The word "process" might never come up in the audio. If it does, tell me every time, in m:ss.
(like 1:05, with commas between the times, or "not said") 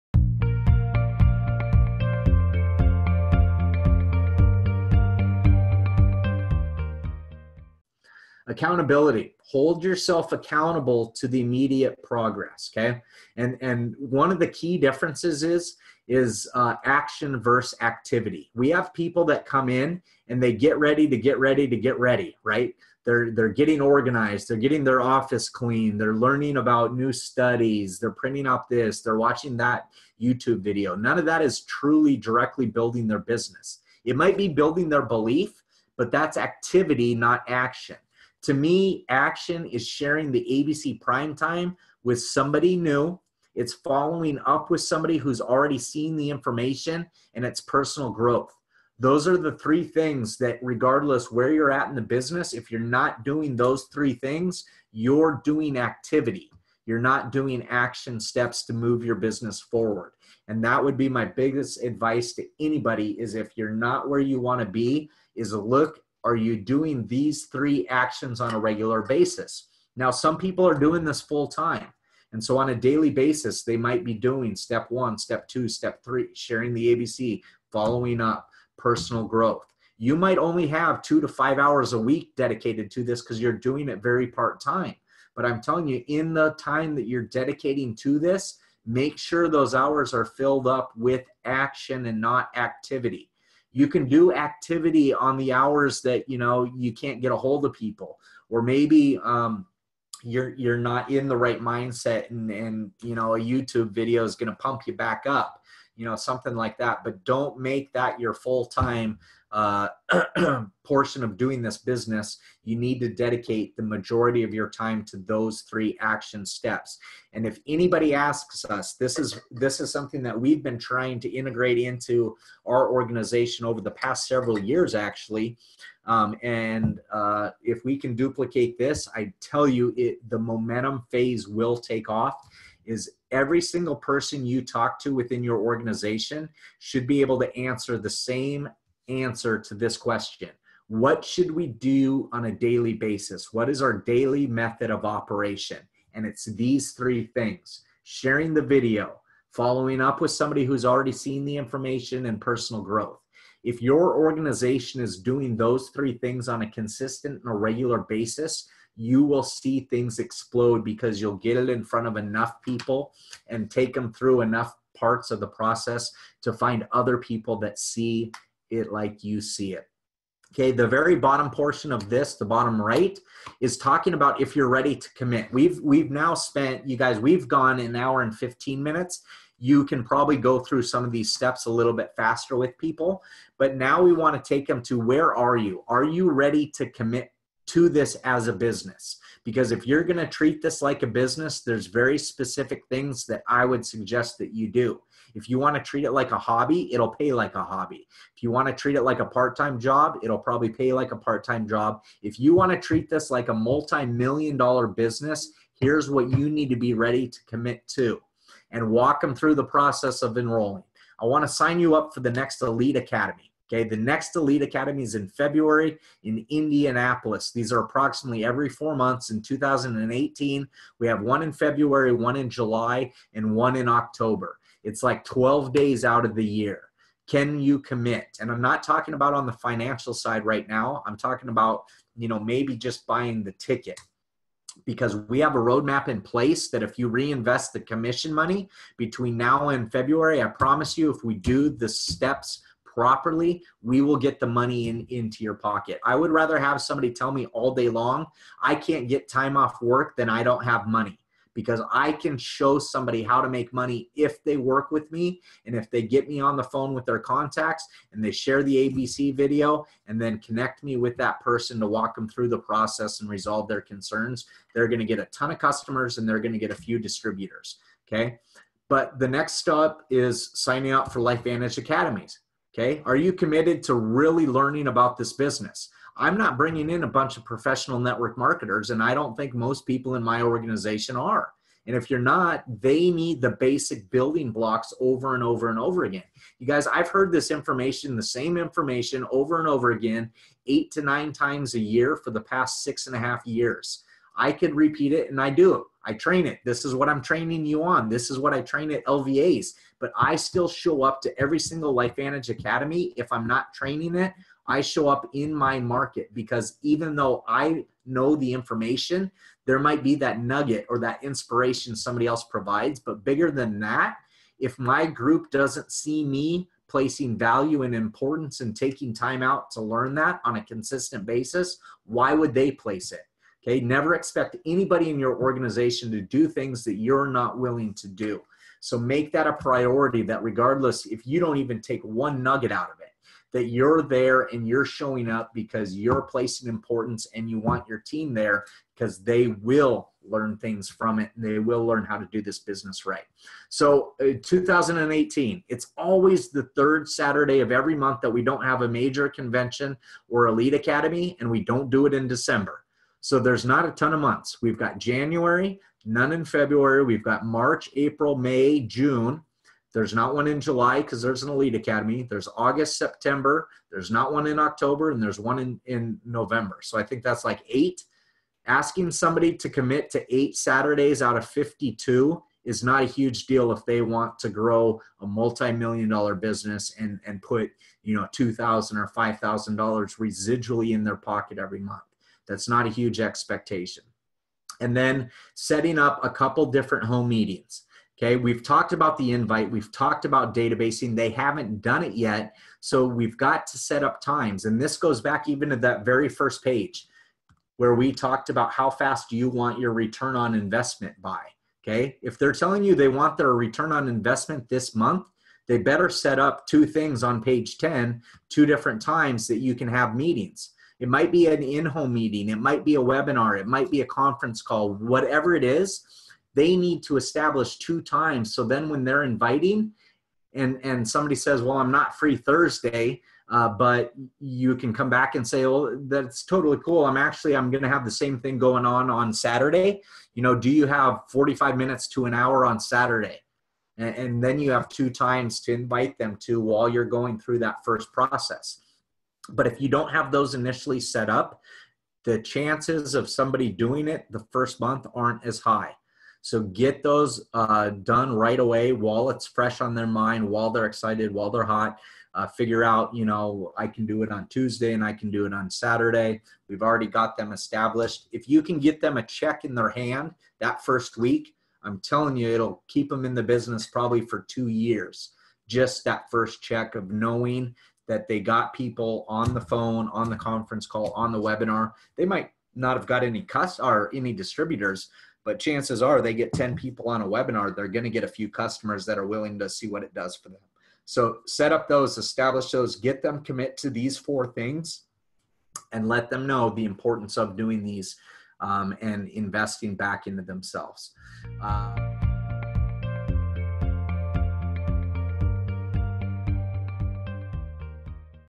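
2:45, 3:29, 4:22, 7:18.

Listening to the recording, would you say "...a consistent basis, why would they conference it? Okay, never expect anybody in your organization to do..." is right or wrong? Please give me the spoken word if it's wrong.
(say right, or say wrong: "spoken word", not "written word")
wrong: "place", not "conference".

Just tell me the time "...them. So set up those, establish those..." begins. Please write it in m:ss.
8:00.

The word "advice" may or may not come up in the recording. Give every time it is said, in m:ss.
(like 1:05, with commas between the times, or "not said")
1:01.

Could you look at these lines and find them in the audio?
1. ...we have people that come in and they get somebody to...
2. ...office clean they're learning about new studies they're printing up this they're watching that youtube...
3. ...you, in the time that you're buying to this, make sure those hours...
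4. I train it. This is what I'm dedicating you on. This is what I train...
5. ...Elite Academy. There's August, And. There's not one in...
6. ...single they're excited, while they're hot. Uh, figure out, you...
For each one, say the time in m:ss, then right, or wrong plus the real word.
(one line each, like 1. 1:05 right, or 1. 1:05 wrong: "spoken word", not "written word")
1. 0:18 wrong: "ready", not "somebody"
2. 0:25 right
3. 1:25 wrong: "dedicating", not "buying"
4. 4:56 wrong: "training", not "dedicating"
5. 6:01 wrong: "September", not "And"
6. 7:30 wrong: "while", not "single".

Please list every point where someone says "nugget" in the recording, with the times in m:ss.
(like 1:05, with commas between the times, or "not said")
5:10, 5:32.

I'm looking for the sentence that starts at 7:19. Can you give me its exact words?
But if you don't have those initially set up, the chances of somebody doing it the first month aren't as high.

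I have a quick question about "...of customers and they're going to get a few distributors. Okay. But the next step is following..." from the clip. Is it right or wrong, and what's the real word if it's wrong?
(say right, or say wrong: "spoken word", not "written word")
wrong: "signing", not "following".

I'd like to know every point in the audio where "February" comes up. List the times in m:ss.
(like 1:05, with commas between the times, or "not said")
3:35, 3:41, 3:59, 5:56.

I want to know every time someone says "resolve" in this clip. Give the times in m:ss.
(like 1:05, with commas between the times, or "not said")
4:23.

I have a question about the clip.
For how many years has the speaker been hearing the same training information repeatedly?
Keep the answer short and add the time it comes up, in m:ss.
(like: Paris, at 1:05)
6 and a half years, at 4:52.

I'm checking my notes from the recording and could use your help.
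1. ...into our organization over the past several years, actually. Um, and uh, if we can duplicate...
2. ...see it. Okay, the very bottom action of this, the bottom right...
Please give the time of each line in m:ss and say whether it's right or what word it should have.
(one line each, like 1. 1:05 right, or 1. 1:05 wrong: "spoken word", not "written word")
1. 2:01 right
2. 2:49 wrong: "portion", not "action".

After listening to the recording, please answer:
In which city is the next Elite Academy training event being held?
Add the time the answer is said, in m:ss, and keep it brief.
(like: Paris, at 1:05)
Indianapolis, at 3:36.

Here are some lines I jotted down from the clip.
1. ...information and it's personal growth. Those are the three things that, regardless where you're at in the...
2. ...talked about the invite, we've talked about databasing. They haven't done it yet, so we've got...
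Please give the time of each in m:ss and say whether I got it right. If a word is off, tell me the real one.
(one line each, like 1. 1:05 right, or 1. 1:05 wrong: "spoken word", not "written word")
1. 0:46 right
2. 6:28 right.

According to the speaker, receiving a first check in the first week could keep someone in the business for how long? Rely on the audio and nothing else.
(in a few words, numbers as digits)
2 years.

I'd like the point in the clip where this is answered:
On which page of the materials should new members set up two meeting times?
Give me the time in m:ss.
6:47.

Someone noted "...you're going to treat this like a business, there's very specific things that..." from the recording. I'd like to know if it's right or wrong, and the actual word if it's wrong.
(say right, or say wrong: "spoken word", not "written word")
right.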